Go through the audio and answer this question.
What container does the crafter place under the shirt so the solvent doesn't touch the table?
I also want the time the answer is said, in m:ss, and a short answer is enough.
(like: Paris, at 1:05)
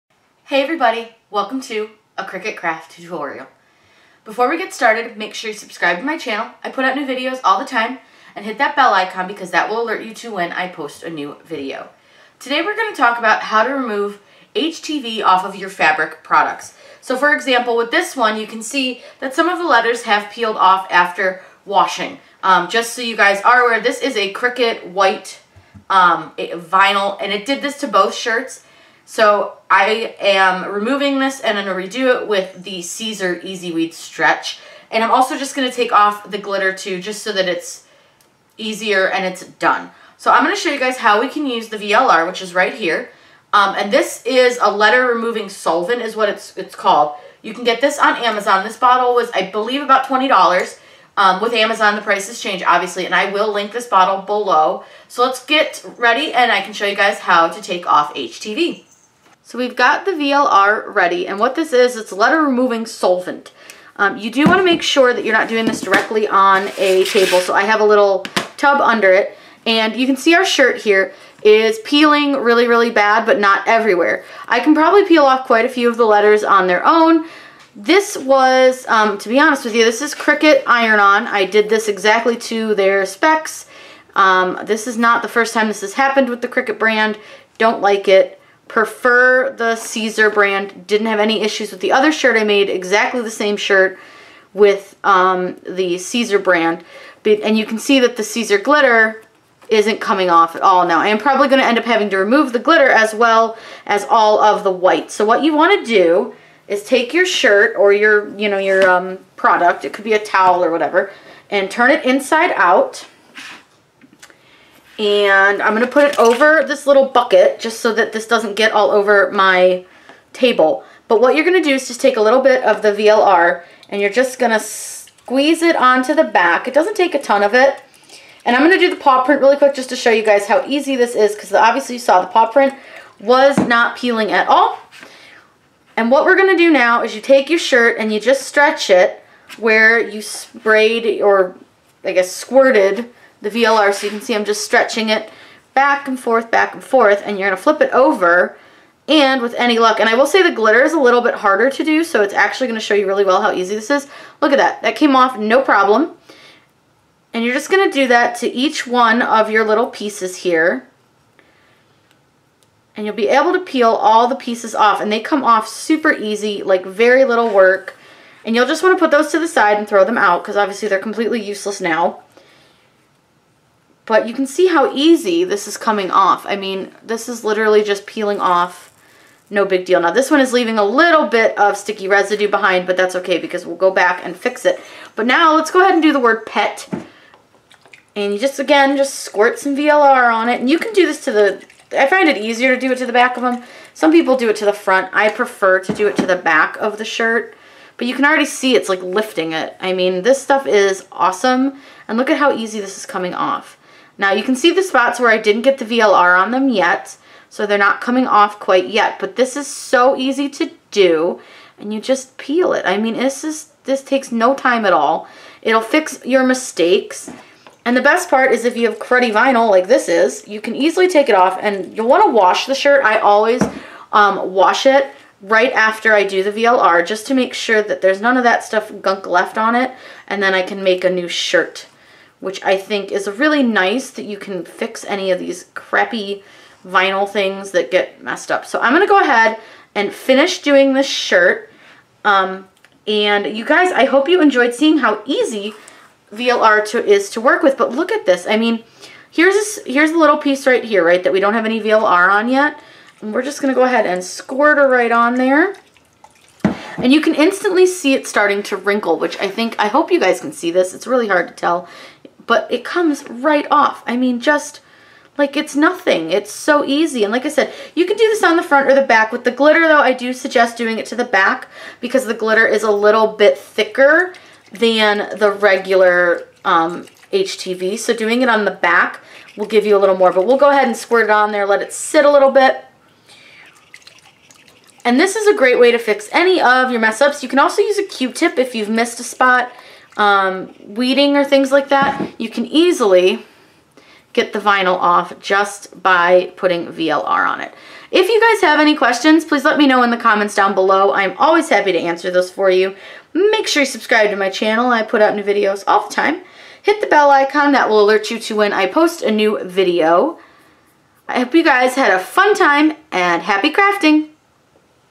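a little tub, at 1:07.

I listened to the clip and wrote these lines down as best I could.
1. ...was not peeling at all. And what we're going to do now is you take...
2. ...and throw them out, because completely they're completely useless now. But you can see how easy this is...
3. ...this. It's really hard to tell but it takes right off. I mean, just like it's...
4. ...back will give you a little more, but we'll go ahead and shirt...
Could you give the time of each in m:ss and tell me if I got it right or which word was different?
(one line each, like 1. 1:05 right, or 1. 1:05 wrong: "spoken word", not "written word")
1. 2:13 right
2. 2:49 wrong: "obviously", not "completely"
3. 4:20 wrong: "comes", not "takes"
4. 4:38 wrong: "squirt", not "shirt".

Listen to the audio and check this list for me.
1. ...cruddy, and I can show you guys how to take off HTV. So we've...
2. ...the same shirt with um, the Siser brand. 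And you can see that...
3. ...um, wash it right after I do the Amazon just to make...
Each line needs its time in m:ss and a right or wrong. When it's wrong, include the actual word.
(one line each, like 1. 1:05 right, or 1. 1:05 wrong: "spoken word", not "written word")
1. 0:55 wrong: "ready", not "cruddy"
2. 1:33 right
3. 3:44 wrong: "VLR", not "Amazon".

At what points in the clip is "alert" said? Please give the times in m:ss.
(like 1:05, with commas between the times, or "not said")
0:09, 5:08.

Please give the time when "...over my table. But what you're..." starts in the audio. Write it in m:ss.
1:58.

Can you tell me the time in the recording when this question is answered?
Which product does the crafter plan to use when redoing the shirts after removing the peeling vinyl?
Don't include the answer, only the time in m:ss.
0:32.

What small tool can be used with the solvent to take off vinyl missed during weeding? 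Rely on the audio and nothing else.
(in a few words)
Q-tip.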